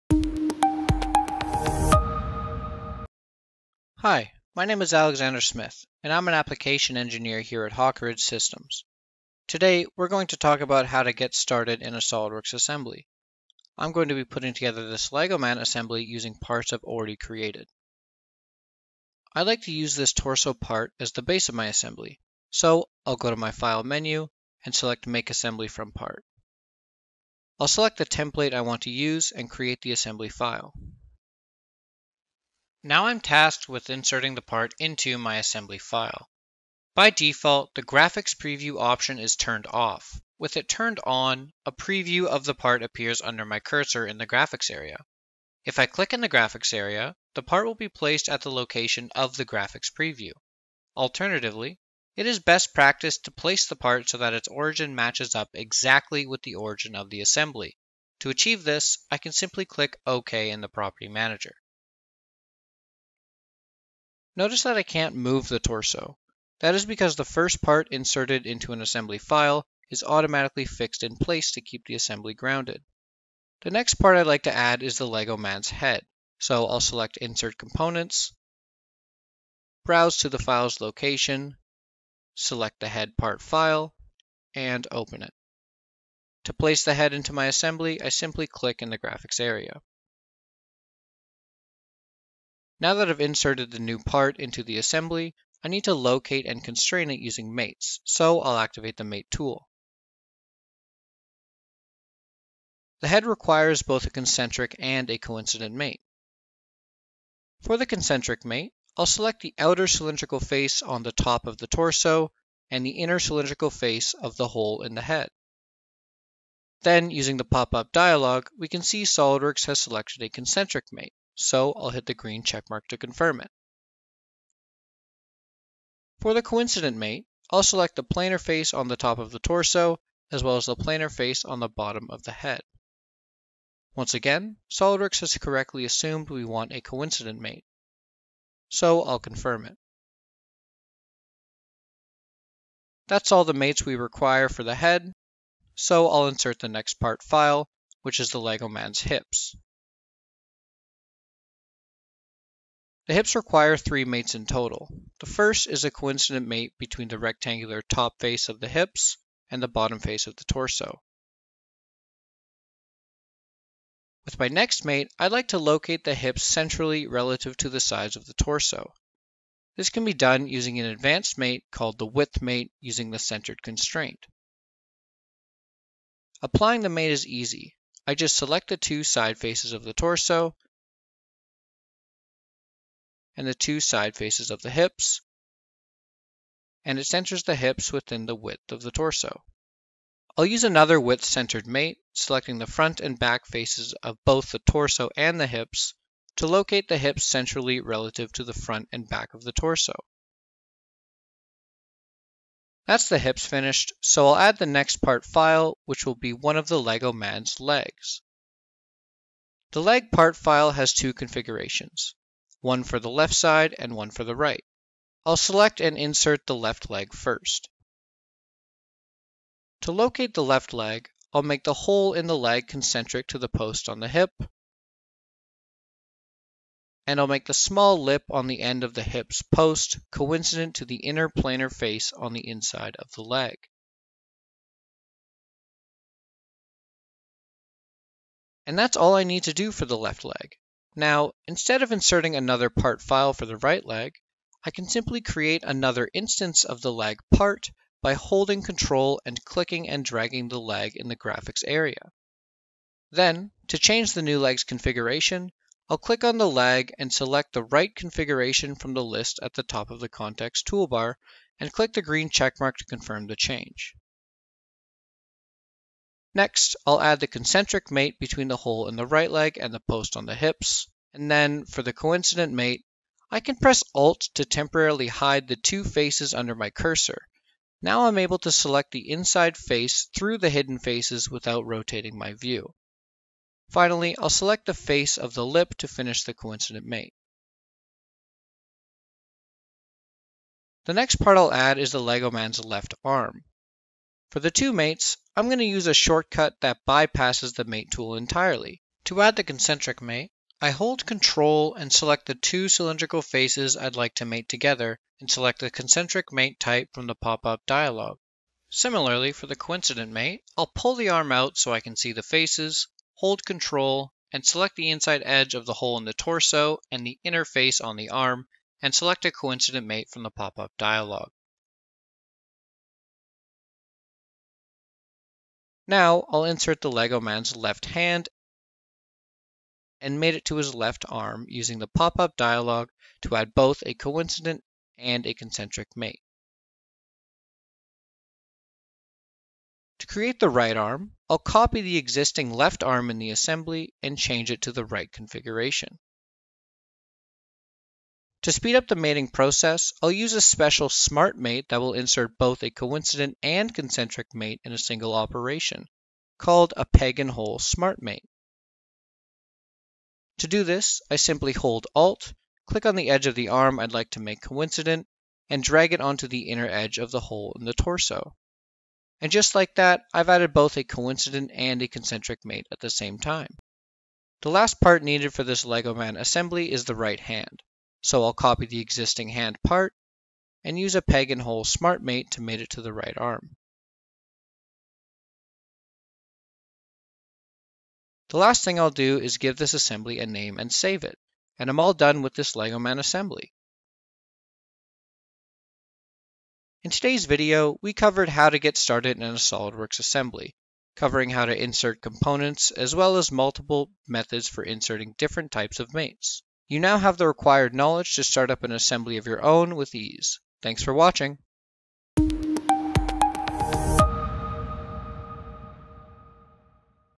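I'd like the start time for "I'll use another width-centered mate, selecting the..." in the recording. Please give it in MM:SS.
03:10.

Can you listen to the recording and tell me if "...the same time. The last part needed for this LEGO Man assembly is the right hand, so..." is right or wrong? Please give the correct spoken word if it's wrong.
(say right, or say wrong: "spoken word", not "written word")
right.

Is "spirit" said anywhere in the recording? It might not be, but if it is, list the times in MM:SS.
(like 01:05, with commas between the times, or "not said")
not said.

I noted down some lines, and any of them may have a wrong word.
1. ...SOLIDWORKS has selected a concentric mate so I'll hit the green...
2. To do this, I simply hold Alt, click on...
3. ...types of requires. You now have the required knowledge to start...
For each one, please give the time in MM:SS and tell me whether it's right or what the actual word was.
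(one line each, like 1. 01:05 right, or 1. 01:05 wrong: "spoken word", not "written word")
1. 01:59 right
2. 06:00 right
3. 06:45 wrong: "mates", not "requires".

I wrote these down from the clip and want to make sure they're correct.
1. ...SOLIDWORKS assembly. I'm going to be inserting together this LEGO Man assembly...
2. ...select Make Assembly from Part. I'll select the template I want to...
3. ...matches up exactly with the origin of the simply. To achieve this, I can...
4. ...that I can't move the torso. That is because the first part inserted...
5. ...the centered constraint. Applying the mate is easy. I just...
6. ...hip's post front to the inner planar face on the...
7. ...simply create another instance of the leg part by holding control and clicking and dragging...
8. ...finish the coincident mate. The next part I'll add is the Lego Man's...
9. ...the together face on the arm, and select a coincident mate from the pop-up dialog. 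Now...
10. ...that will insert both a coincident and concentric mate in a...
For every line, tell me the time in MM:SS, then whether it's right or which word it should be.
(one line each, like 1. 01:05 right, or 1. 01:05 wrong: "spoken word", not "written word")
1. 00:12 wrong: "putting", not "inserting"
2. 00:24 right
3. 00:54 wrong: "assembly", not "simply"
4. 01:04 right
5. 02:53 right
6. 03:49 wrong: "coincident", not "front"
7. 04:04 right
8. 04:45 right
9. 05:17 wrong: "inner", not "together"
10. 05:51 right.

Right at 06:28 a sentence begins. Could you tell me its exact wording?
The last thing I'll do is give this assembly a name and save it.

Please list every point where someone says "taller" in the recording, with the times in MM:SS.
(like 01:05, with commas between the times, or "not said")
not said.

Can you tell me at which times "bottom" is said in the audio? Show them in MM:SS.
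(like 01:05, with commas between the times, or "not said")
02:11, 02:39.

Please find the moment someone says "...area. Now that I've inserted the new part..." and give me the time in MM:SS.
01:29.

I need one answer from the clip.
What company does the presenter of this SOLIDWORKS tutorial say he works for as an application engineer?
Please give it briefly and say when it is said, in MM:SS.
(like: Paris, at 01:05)
Hawk Ridge Systems, at 00:07.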